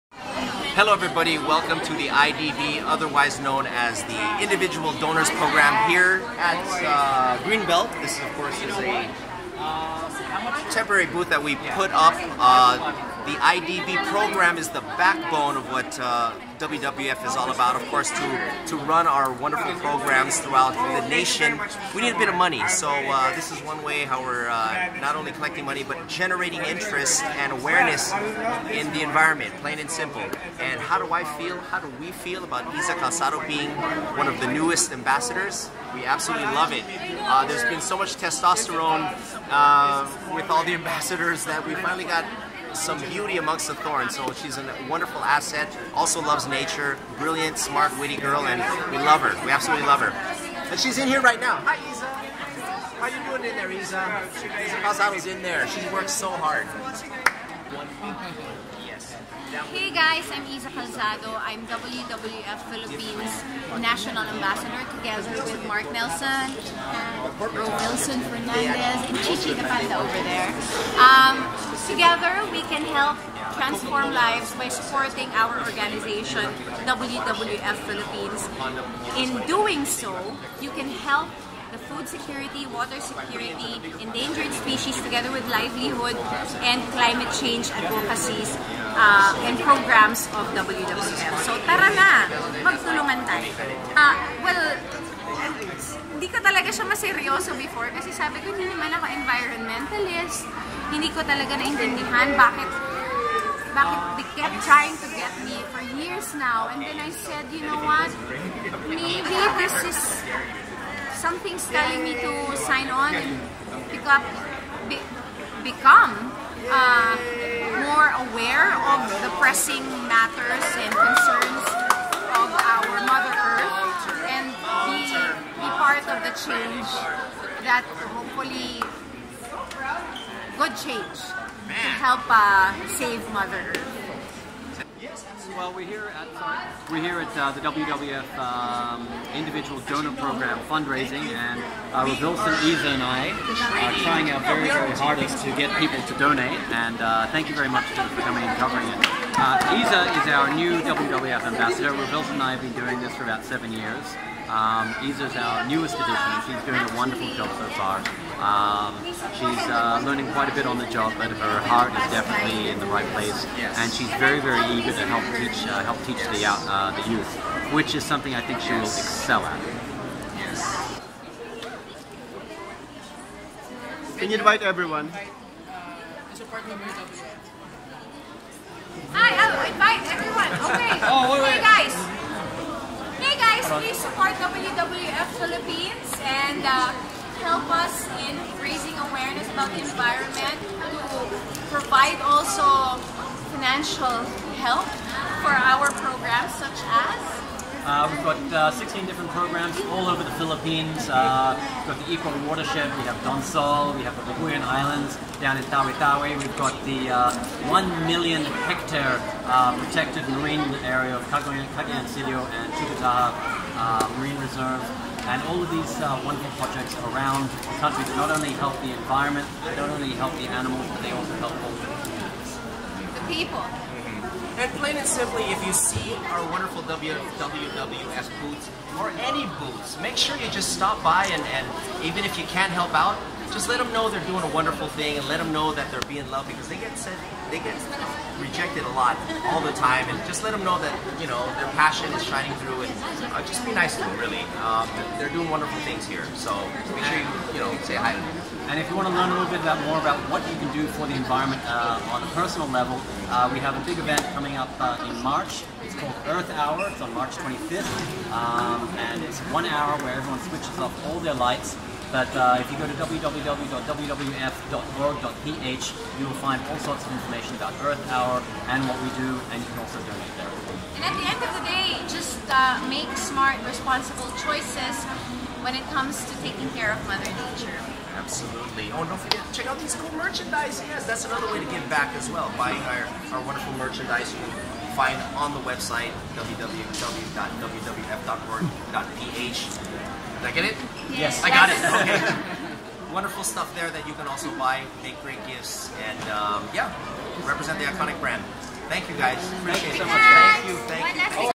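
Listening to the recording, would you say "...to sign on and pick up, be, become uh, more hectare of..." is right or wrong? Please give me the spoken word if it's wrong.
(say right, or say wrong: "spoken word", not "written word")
wrong: "aware", not "hectare".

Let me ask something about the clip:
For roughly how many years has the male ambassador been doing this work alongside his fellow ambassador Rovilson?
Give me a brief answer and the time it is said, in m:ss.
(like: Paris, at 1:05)
7, at 2:33.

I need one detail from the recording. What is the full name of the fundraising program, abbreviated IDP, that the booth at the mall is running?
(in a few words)
Individual Donors Program.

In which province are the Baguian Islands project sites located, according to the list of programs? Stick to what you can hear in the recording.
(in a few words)
Tawi Tawi.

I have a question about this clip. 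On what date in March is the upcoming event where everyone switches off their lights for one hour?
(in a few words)
March 25.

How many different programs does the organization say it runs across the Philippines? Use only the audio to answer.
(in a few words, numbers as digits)
16.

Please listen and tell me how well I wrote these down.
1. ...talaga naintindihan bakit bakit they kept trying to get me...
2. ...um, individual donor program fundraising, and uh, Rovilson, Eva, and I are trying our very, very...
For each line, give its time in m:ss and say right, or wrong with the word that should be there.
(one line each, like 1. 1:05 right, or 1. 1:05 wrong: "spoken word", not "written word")
1. 1:41 right
2. 2:18 right.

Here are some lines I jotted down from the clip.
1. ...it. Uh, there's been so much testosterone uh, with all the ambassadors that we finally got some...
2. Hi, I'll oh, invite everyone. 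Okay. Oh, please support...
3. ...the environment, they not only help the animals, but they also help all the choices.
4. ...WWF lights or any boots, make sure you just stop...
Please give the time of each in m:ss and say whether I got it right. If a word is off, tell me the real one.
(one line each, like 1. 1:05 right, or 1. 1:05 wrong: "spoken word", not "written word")
1. 0:36 right
2. 2:59 right
3. 3:38 wrong: "communities", not "choices"
4. 3:46 wrong: "boots", not "lights".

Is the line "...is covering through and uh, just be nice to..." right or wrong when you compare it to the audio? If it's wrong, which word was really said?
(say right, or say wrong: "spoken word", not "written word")
wrong: "shining", not "covering".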